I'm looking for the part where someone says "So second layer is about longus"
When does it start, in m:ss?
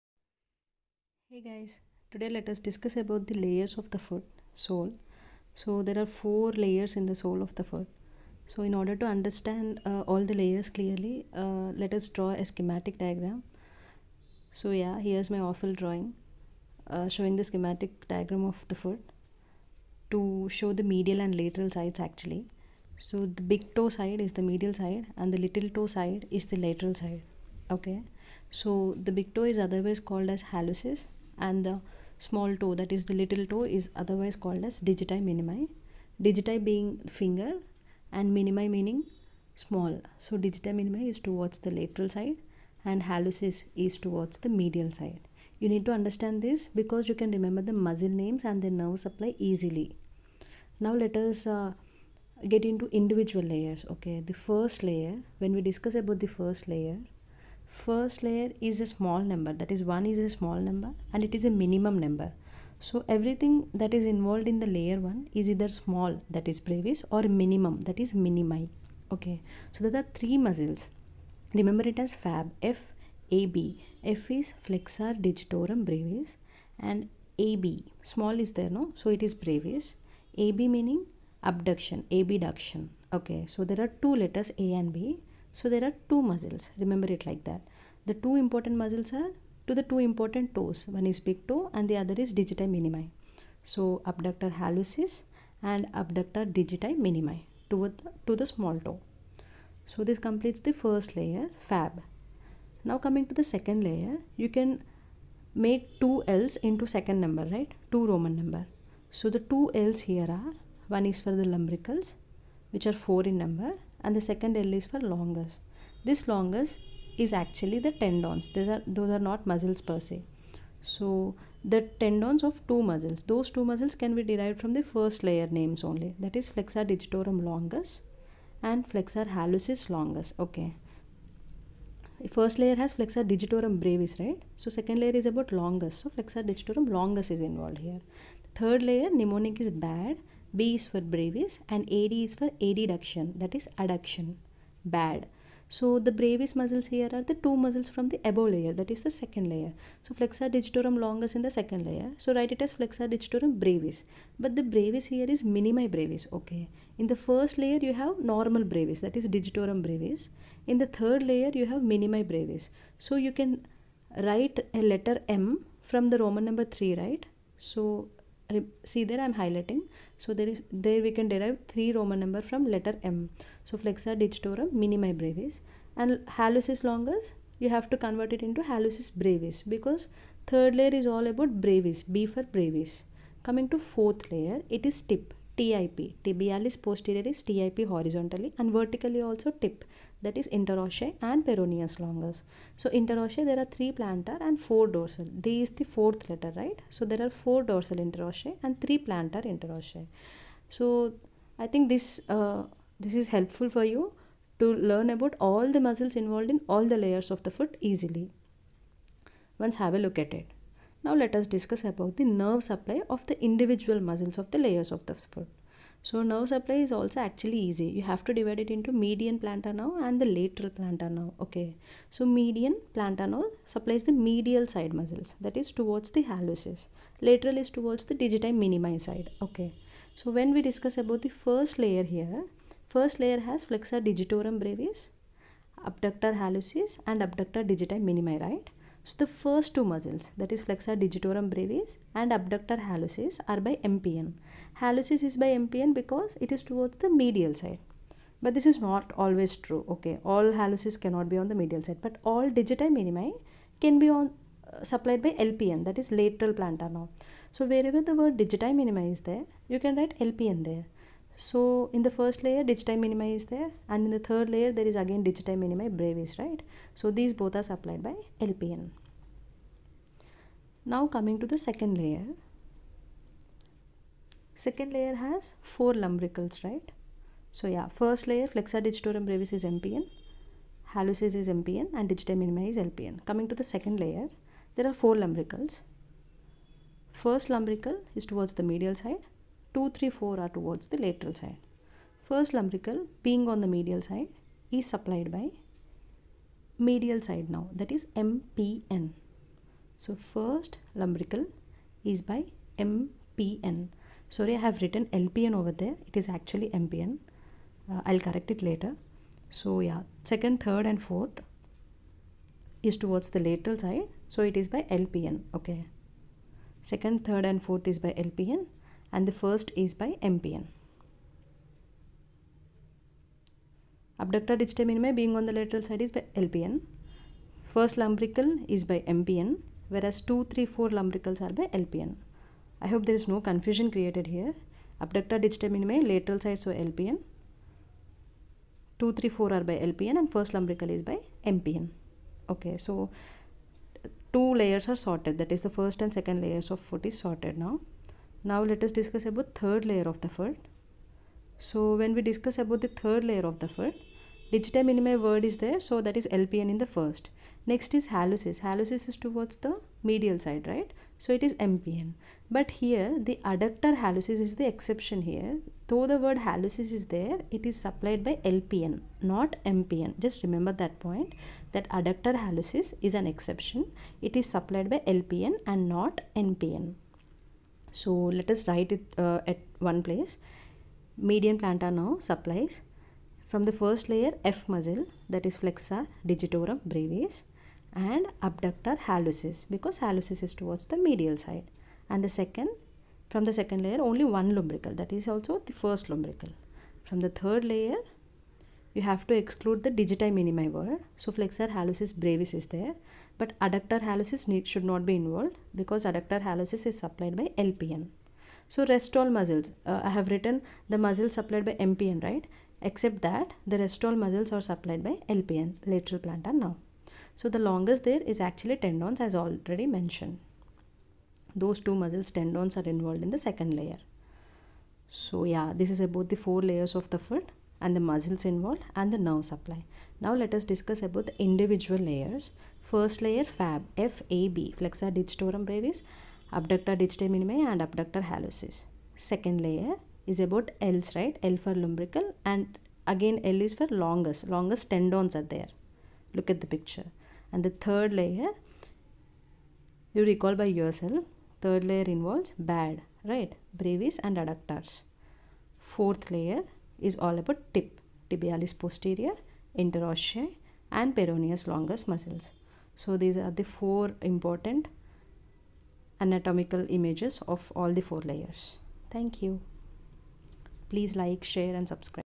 2:14.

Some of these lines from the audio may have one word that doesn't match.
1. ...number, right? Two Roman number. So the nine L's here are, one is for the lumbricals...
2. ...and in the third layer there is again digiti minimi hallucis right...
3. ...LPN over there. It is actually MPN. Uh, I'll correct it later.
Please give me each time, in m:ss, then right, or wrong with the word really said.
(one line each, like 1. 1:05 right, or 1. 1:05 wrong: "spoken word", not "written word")
1. 1:47 wrong: "two", not "nine"
2. 4:23 wrong: "brevis", not "hallucis"
3. 5:05 right.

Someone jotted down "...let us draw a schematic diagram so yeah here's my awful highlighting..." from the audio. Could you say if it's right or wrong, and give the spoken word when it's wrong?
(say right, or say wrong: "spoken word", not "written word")
wrong: "drawing", not "highlighting".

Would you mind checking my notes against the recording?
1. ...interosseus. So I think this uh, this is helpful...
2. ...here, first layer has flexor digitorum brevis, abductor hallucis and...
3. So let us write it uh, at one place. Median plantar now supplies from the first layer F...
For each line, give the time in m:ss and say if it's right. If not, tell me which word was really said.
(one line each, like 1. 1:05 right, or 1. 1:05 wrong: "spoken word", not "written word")
1. 3:19 right
2. 3:52 right
3. 6:17 right.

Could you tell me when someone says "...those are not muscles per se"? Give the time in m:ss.
1:58.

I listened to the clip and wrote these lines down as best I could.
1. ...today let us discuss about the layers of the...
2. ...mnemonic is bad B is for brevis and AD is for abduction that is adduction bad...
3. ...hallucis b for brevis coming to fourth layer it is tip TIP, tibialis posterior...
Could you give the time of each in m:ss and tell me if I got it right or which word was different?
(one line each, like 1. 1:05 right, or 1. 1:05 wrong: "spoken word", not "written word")
1. 0:02 right
2. 2:19 wrong: "adduction", not "abduction"
3. 3:01 wrong: "brevis", not "hallucis".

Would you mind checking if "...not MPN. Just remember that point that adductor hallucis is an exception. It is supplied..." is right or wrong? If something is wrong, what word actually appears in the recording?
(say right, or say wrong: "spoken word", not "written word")
right.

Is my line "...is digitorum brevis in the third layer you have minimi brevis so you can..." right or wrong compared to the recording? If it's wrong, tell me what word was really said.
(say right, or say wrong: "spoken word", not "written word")
right.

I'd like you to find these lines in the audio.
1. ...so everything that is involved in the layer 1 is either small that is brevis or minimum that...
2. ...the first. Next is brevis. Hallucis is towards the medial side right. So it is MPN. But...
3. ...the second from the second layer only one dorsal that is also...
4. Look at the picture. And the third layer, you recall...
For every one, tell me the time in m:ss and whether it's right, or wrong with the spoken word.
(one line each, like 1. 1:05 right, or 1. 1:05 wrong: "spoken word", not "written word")
1. 1:02 right
2. 5:56 wrong: "hallucis", not "brevis"
3. 6:32 wrong: "lumbrical", not "dorsal"
4. 7:26 right.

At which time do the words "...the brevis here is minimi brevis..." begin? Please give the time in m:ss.
2:34.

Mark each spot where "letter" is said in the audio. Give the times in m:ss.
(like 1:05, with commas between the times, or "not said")
1:24, 2:44, 2:52, 3:16.